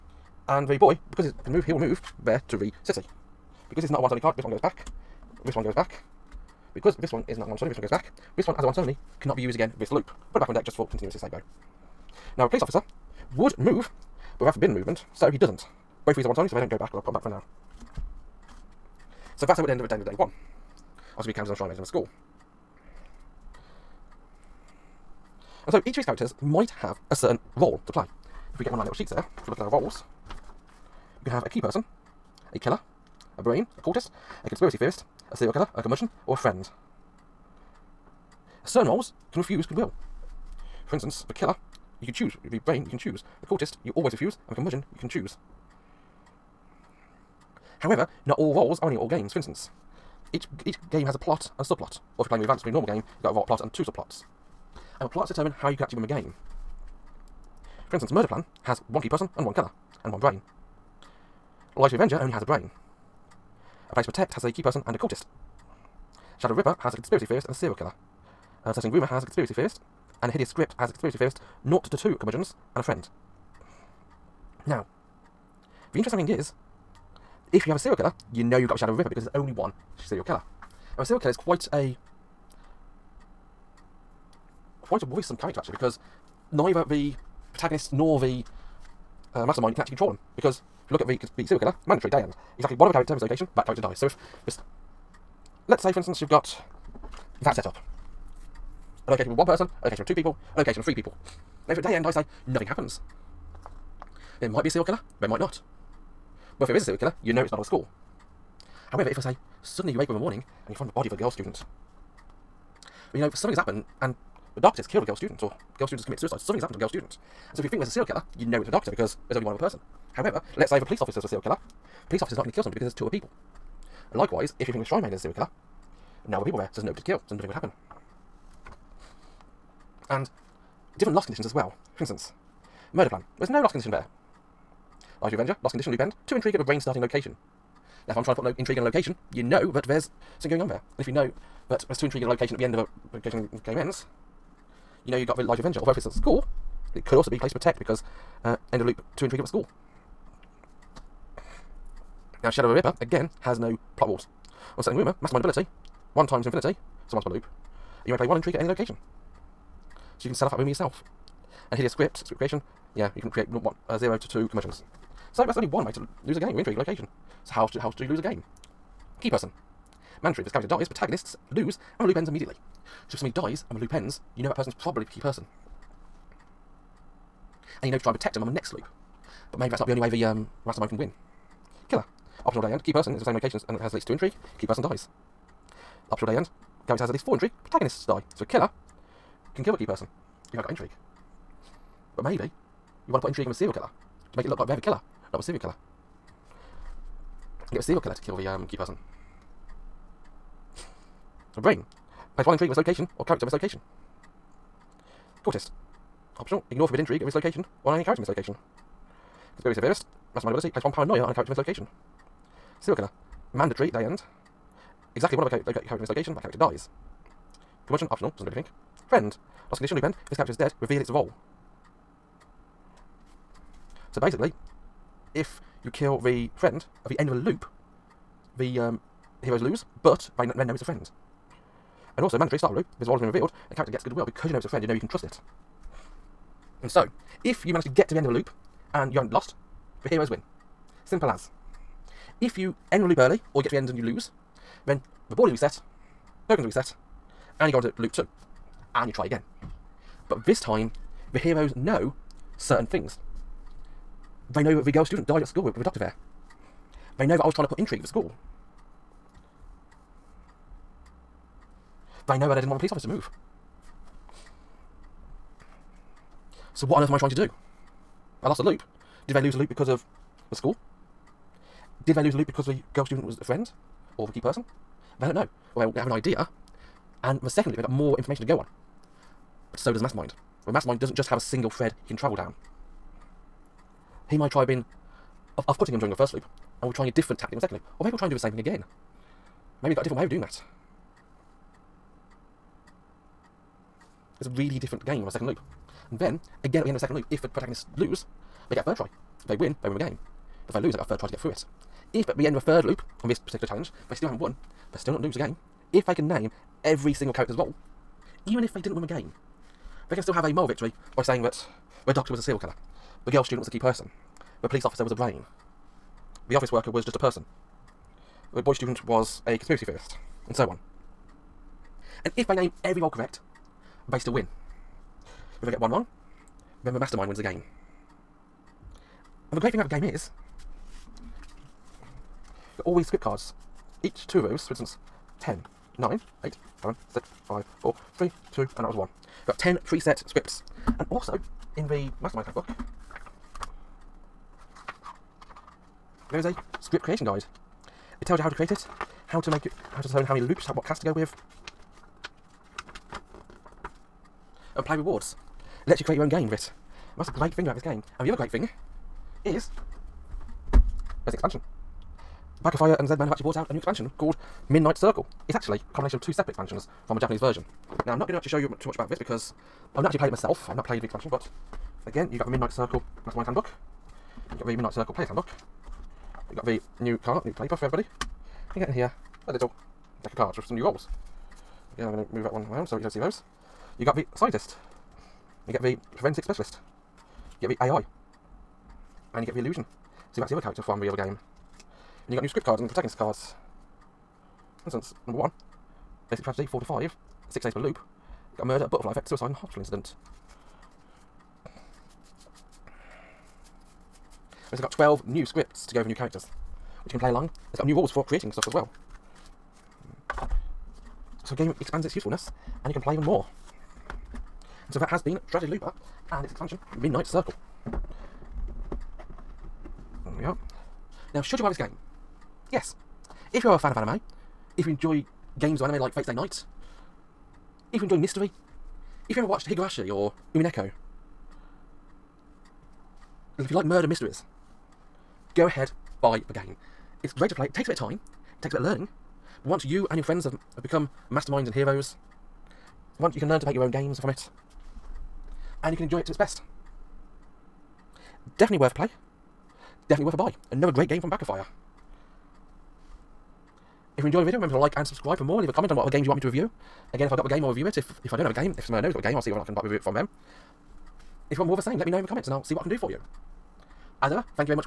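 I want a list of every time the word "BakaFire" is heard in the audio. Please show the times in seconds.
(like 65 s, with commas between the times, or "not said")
362 s, 451 s.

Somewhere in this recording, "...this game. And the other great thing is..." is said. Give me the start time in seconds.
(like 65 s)
357 s.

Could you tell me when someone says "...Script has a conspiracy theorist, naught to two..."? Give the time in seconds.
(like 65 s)
70 s.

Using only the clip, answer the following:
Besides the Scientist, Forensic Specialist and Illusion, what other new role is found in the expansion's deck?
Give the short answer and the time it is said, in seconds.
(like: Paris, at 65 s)
AI, at 387 s.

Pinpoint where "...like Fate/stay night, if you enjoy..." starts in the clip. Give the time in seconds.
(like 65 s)
425 s.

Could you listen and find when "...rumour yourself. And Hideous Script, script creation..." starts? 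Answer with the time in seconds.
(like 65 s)
160 s.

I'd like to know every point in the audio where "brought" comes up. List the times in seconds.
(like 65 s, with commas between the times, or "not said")
363 s.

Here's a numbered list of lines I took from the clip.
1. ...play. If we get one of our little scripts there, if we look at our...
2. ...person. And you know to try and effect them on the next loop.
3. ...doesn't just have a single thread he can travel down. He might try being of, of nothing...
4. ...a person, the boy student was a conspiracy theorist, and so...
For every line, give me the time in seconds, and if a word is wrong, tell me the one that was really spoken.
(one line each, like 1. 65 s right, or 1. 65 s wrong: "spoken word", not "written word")
1. 27 s wrong: "sheets", not "scripts"
2. 175 s wrong: "protect", not "effect"
3. 280 s wrong: "putting", not "nothing"
4. 317 s right.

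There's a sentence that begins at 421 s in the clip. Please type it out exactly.
Now, should you buy this game?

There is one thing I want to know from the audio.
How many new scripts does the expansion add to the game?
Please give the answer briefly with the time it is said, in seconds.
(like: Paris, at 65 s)
12, at 404 s.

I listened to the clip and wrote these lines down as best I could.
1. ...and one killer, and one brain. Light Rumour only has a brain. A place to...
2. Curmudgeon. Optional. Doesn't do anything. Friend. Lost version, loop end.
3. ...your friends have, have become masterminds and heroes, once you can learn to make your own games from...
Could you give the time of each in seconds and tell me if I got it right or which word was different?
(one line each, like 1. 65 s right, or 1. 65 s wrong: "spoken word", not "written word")
1. 59 s wrong: "Avenger", not "Rumour"
2. 217 s wrong: "condition", not "version"
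3. 440 s right.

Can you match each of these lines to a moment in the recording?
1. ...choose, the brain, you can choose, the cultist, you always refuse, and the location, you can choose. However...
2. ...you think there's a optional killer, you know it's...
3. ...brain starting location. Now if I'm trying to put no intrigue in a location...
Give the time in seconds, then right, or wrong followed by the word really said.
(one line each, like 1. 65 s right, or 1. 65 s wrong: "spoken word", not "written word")
1. 42 s wrong: "curmudgeon", not "location"
2. 117 s wrong: "serial", not "optional"
3. 136 s right.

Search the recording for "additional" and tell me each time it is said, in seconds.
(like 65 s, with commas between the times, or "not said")
not said.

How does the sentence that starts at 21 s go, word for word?
Also be counted on Shrine Maiden of a school.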